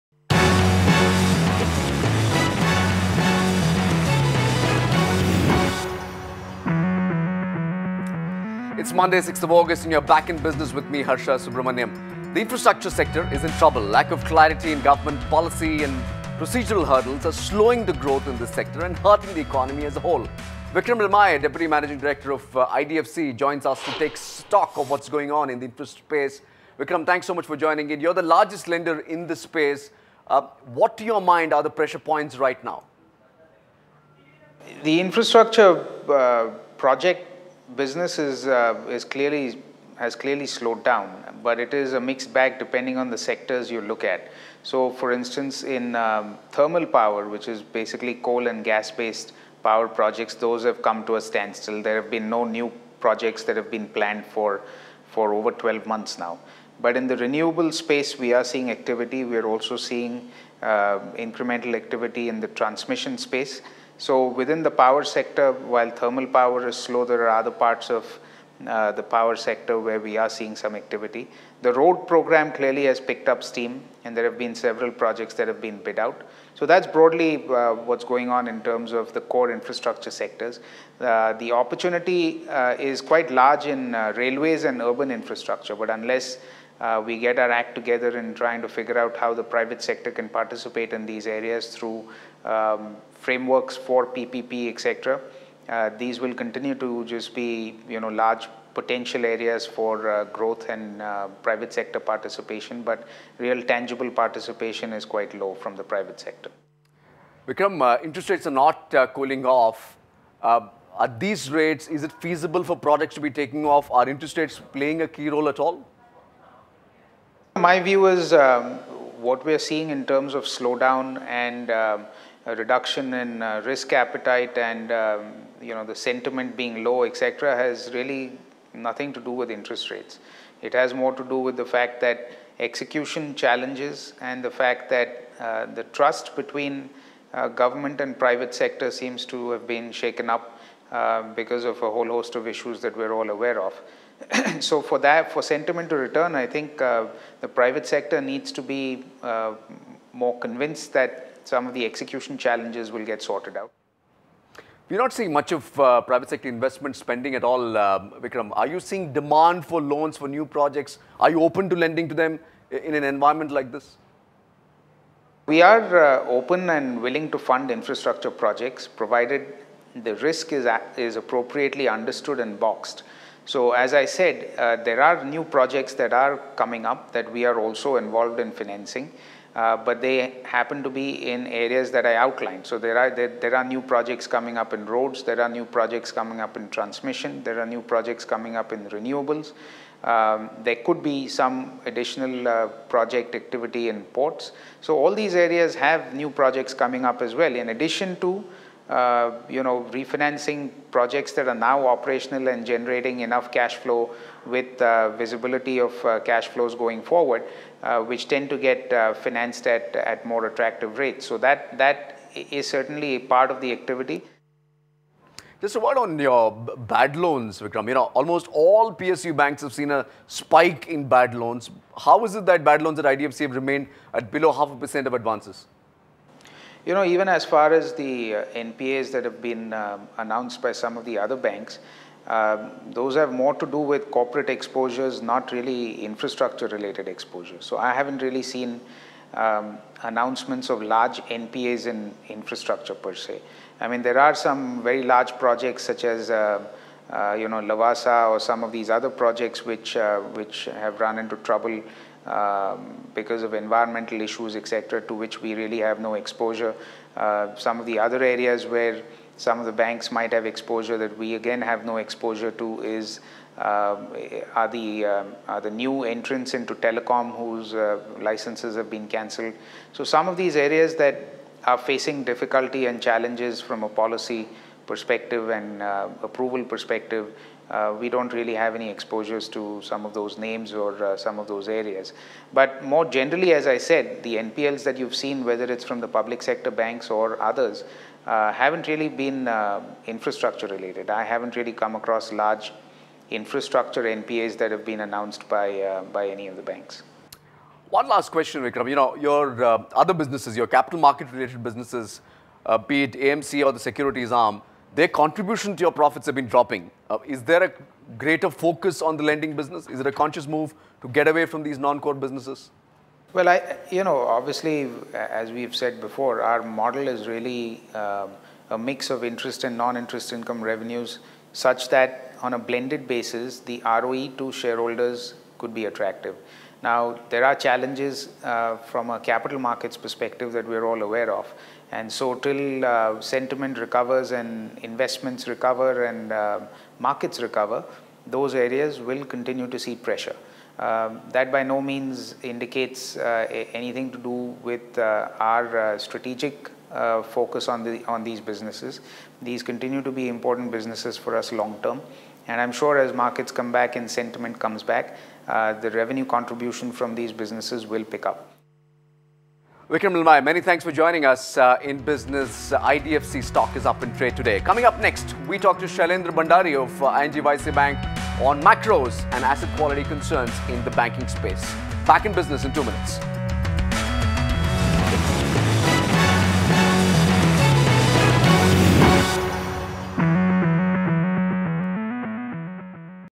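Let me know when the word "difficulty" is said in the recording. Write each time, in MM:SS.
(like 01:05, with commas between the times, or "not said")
04:32.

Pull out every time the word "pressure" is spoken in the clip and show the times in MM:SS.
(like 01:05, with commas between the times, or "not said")
00:31, 05:39.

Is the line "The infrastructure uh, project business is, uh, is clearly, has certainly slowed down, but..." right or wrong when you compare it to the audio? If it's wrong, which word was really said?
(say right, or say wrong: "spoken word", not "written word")
wrong: "clearly", not "certainly".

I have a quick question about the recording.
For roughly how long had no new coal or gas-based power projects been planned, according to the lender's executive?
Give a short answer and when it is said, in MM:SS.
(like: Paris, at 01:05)
over 12 months, at 00:55.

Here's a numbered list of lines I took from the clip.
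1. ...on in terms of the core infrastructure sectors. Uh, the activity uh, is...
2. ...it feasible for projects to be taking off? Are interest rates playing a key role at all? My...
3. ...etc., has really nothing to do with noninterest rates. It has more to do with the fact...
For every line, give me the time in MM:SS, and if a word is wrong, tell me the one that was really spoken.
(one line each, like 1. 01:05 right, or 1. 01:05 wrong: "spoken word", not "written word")
1. 01:18 wrong: "opportunity", not "activity"
2. 01:52 right
3. 02:07 wrong: "interest", not "noninterest".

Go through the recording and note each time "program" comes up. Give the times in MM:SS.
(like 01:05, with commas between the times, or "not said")
01:12.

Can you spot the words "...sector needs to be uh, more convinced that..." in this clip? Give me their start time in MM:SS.
02:27.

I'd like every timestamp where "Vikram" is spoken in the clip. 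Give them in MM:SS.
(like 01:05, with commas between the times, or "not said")
00:20, 00:26, 01:47, 02:38, 03:37, 04:58, 05:59.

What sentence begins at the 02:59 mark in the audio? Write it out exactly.
Uh, but they happen to be in areas that I outlined.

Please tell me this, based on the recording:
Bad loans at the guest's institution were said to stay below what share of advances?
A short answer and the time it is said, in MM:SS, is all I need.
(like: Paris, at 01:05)
half a percent, at 03:44.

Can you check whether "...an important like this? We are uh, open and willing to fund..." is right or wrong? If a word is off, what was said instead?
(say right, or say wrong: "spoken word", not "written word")
wrong: "environment", not "important".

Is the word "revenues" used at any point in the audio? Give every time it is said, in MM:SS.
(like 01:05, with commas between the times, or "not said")
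05:20, 05:55.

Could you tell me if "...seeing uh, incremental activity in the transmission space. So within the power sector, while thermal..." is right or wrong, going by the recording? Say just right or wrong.
right.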